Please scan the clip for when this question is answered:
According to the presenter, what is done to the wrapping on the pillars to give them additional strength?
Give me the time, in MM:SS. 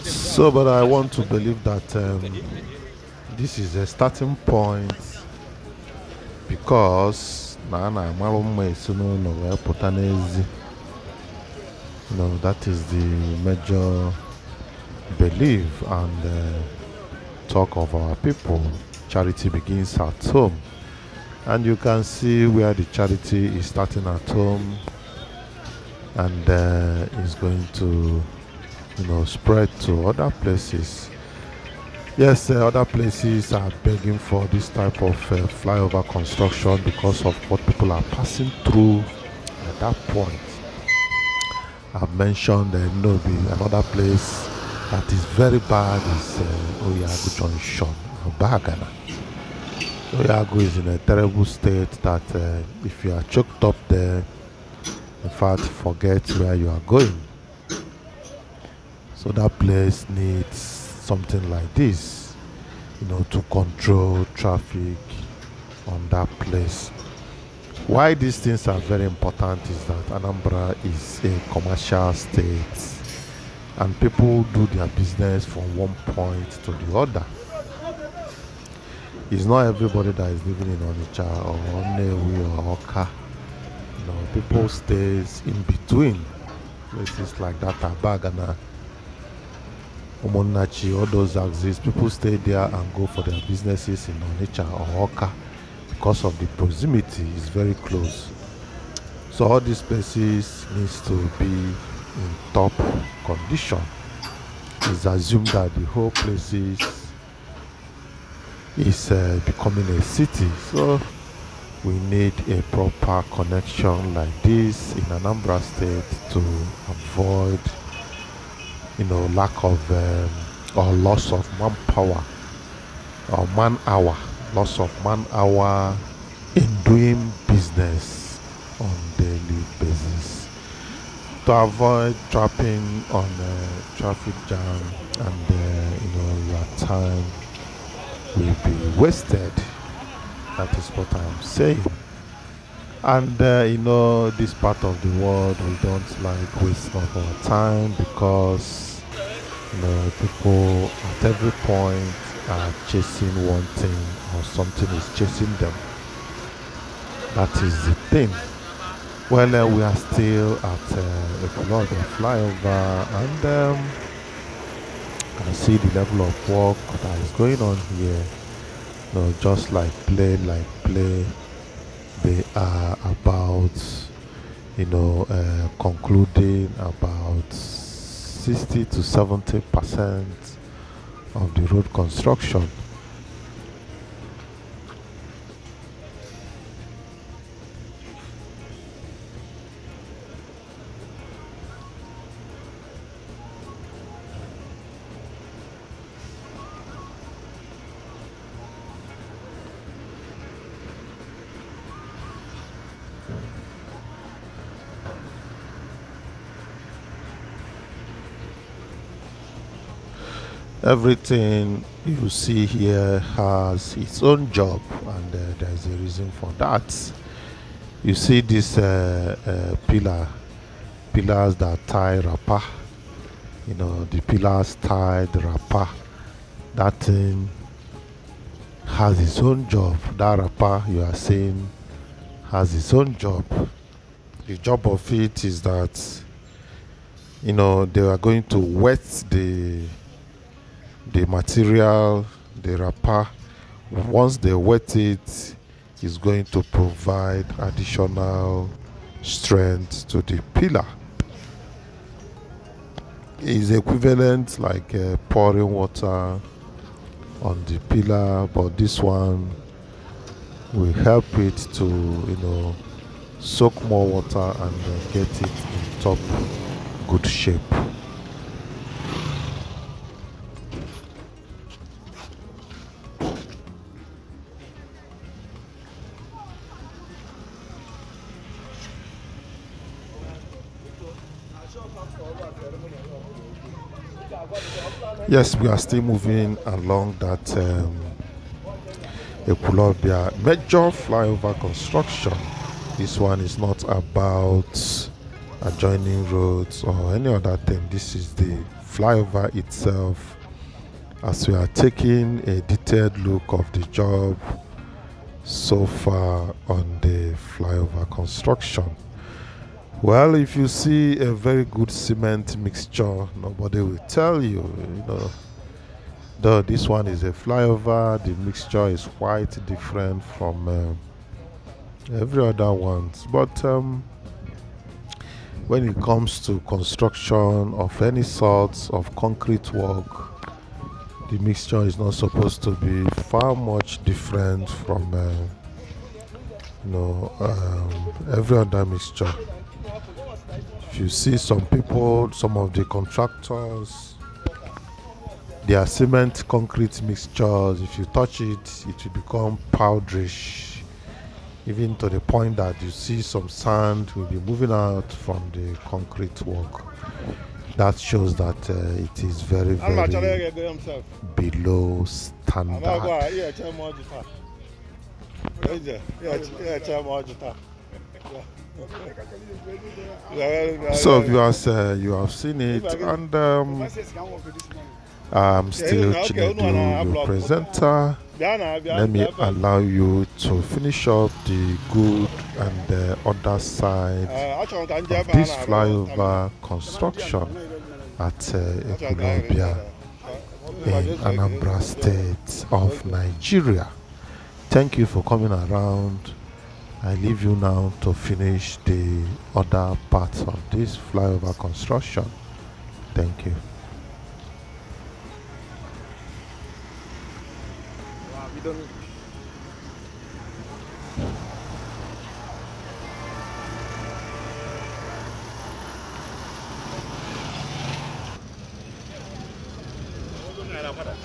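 04:04.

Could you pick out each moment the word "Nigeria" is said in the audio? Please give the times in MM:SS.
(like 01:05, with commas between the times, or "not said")
06:33.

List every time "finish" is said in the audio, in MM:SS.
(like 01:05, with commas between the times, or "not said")
06:20, 06:38.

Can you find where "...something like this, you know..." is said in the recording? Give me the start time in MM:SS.
01:00.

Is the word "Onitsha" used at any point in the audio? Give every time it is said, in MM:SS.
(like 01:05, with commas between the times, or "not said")
01:20, 01:34.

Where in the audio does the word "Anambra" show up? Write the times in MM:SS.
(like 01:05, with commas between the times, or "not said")
01:10, 01:55, 06:31.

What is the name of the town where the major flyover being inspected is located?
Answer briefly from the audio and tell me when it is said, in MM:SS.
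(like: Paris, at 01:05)
Ekulobia, at 04:49.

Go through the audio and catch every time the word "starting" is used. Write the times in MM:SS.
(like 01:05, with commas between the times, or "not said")
00:03, 00:23.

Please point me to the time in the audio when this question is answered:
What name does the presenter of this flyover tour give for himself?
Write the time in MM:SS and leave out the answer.
06:16.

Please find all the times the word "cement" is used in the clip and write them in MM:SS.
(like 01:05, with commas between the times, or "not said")
05:11, 05:45.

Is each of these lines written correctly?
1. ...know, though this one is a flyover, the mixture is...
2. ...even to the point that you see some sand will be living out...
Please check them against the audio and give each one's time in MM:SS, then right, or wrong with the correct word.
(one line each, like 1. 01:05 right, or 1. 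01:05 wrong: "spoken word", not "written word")
1. 05:15 right
2. 05:51 wrong: "moving", not "living".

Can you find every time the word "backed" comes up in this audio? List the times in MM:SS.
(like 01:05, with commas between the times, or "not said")
not said.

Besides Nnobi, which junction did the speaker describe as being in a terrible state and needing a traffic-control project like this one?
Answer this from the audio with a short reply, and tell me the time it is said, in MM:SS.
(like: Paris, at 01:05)
Oyago Junction, at 00:46.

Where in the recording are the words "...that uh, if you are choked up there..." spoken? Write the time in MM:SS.
00:52.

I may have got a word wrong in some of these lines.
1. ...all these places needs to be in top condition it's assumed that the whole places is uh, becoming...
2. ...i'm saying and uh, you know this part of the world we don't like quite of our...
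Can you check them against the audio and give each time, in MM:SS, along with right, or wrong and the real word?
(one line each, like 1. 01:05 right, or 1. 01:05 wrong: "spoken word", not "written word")
1. 01:39 right
2. 02:21 wrong: "waste", not "quite".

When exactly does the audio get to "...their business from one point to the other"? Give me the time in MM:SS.
01:14.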